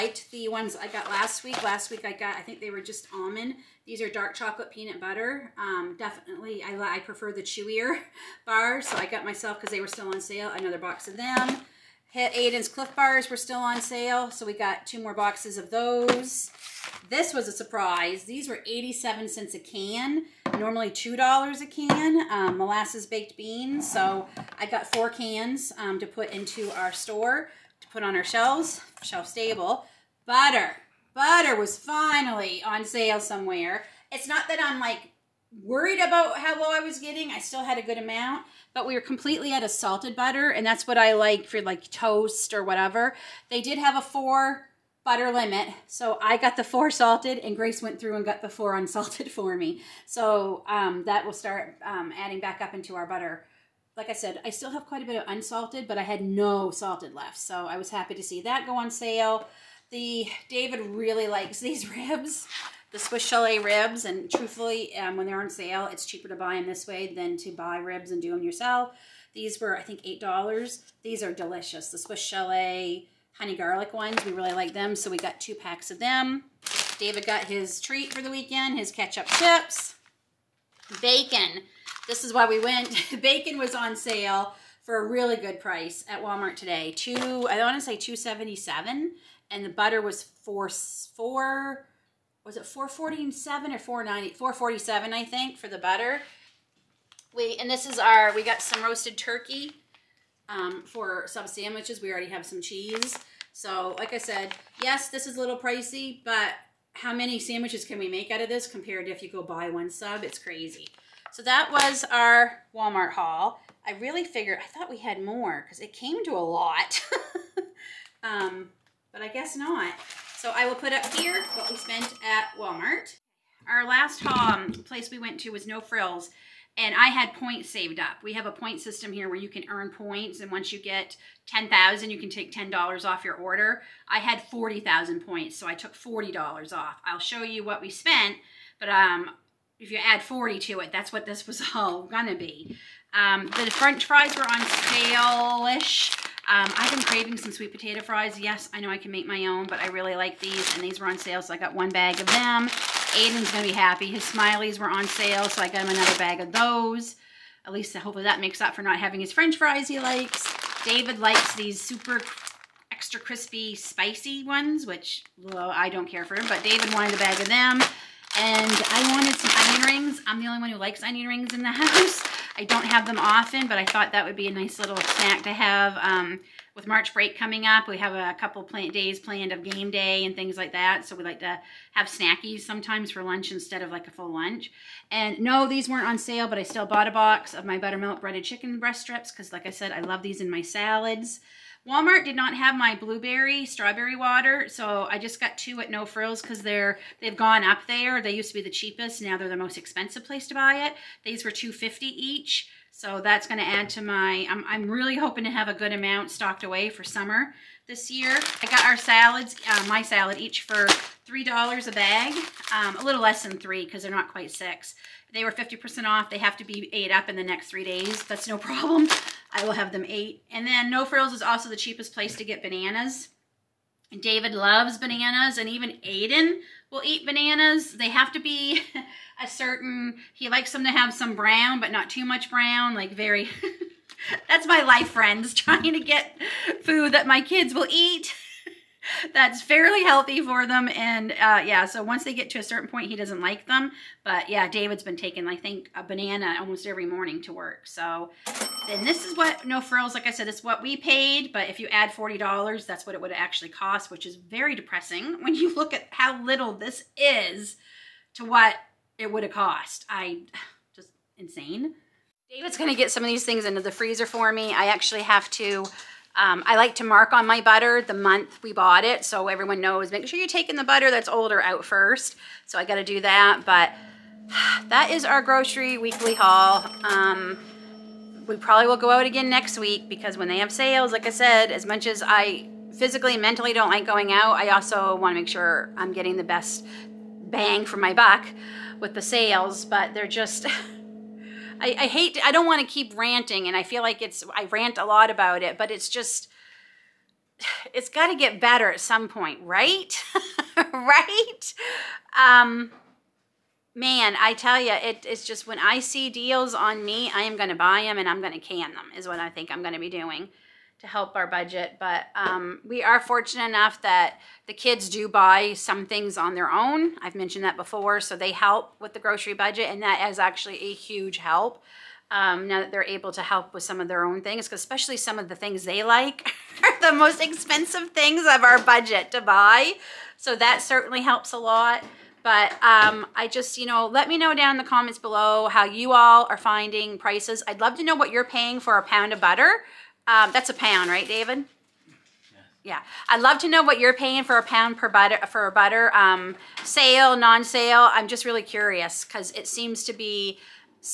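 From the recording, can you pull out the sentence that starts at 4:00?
And uh, yeah, so once they get to a certain point, he doesn't like them.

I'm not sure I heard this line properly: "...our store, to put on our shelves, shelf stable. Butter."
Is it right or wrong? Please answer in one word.
right.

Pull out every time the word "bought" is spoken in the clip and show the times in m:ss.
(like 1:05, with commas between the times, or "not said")
3:06, 4:28.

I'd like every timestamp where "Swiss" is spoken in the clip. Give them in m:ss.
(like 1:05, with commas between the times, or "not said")
1:02, 1:11.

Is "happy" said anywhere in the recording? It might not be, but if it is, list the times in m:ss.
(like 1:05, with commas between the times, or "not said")
0:57, 2:33.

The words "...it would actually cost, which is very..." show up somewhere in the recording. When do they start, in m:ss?
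4:13.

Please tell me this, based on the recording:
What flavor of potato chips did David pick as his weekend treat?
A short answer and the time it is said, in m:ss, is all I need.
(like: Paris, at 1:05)
ketchup, at 1:18.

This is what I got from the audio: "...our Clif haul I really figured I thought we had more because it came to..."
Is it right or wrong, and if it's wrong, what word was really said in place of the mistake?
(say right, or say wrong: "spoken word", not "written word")
wrong: "Walmart", not "Clif".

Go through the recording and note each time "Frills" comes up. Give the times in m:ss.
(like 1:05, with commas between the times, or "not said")
2:05, 3:16, 3:41, 4:09.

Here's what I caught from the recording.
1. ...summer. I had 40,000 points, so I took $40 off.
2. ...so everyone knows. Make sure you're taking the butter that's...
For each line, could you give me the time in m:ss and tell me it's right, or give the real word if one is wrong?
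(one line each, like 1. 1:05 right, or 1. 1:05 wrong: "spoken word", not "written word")
1. 2:13 wrong: "order", not "summer"
2. 4:29 right.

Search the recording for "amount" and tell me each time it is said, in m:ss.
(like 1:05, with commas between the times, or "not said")
0:37, 3:25.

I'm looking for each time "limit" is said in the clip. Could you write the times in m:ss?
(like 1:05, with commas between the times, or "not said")
0:45.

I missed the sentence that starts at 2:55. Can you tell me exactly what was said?
Um, with March break coming up, we have a couple plant days planned of game day and things like that.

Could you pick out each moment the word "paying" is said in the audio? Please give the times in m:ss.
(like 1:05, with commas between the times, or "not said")
5:38, 5:44.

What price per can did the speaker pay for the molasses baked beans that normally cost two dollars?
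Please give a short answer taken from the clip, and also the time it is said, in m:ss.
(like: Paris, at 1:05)
87 cents, at 0:18.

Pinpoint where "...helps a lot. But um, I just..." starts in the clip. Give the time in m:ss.
5:31.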